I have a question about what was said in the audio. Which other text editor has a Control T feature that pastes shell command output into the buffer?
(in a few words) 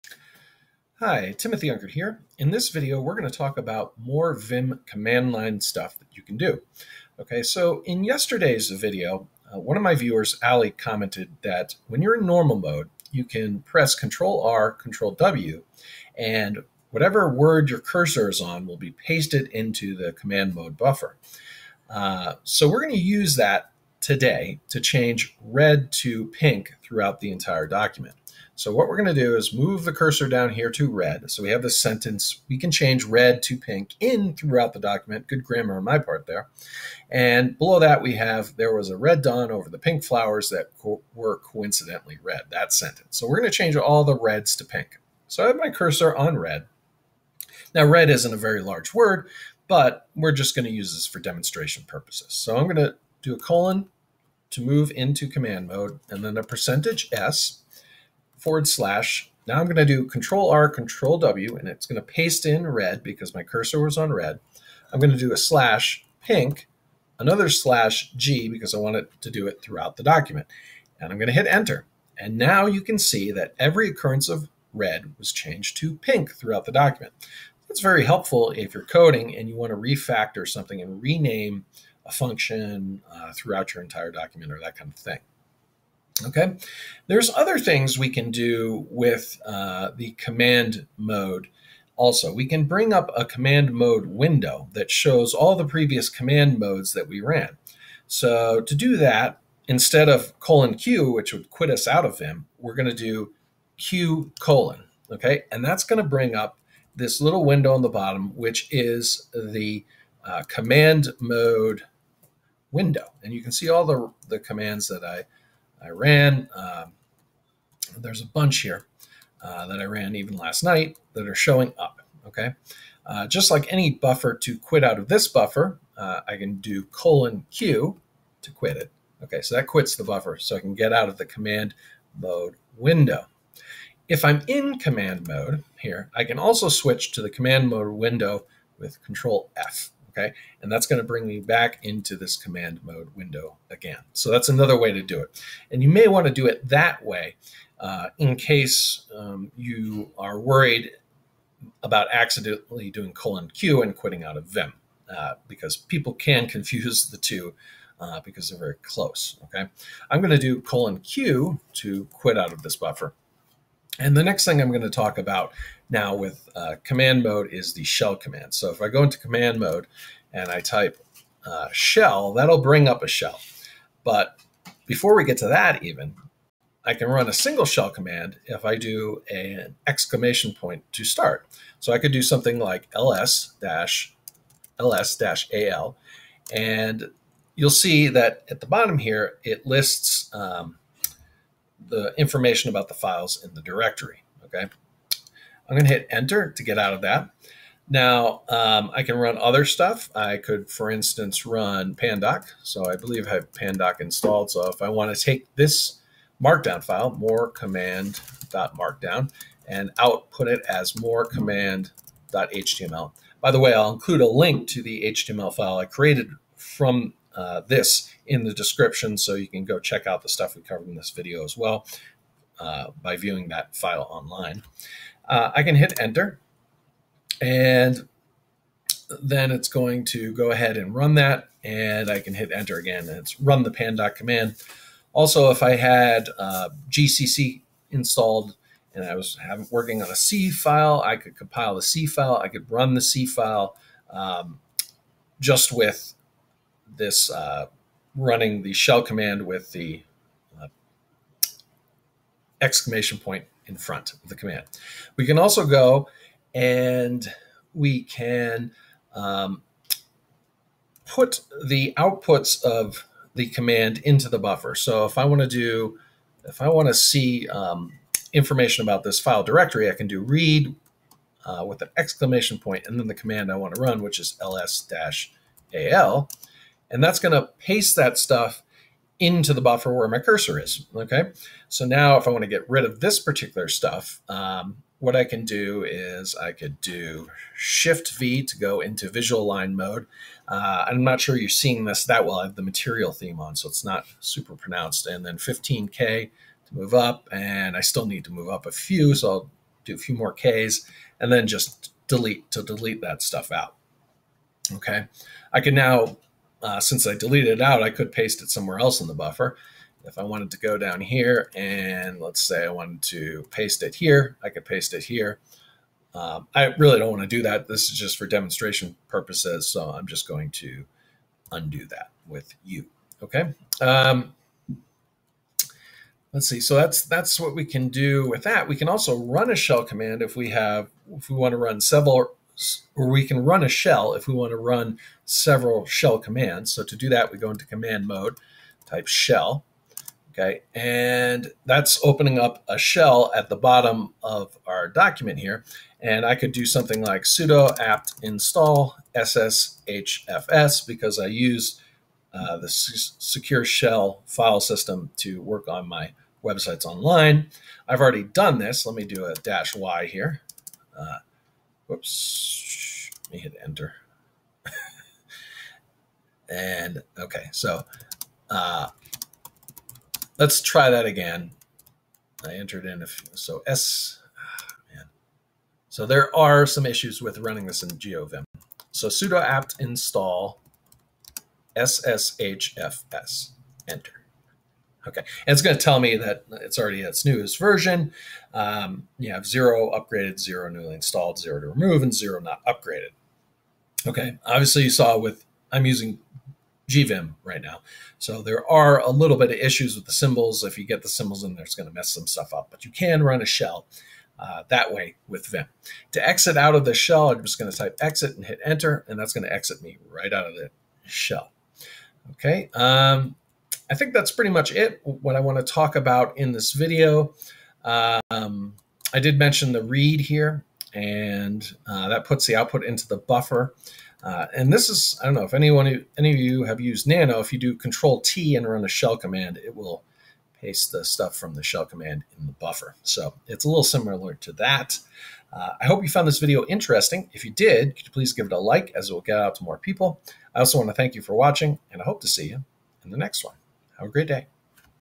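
Nano.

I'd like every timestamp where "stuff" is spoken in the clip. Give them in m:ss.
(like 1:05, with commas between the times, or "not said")
0:05, 3:19, 3:40, 4:38, 4:43, 5:03, 6:42, 7:11.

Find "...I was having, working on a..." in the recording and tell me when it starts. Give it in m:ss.
3:59.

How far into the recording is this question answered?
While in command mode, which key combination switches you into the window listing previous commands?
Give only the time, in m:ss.
2:19.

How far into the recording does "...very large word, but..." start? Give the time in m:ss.
0:48.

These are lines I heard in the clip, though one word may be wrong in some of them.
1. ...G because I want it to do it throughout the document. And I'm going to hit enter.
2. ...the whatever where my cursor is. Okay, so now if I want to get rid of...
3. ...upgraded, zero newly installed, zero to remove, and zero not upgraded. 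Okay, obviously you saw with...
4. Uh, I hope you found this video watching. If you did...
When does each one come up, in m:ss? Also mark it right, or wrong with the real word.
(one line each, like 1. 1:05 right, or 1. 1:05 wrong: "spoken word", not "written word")
1. 1:08 right
2. 4:39 wrong: "buffer", not "whatever"
3. 6:29 right
4. 7:15 wrong: "interesting", not "watching".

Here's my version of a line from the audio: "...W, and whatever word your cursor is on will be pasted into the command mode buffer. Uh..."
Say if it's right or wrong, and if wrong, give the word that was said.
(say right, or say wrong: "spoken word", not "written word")
right.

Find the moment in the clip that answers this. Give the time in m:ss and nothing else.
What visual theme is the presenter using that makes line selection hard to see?
4:52.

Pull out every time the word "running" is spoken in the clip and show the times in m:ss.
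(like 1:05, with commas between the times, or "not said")
4:08, 6:17.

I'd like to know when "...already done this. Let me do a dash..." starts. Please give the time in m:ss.
5:58.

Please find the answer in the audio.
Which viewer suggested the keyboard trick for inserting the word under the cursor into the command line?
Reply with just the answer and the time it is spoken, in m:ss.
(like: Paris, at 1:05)
Ali, at 0:10.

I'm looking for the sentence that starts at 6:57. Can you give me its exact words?
Um, I did mention the read here and uh, that puts the output into the buffer.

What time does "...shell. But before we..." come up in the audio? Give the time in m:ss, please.
2:53.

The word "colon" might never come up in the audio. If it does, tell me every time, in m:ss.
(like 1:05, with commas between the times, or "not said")
0:53, 1:40, 1:44, 2:06, 2:33, 2:40.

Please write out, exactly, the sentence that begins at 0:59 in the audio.
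Now I'm going to do Control R, Control W, and it's going to paste in red because my cursor was on red.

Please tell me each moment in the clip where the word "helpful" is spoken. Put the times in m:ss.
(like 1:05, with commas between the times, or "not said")
1:18.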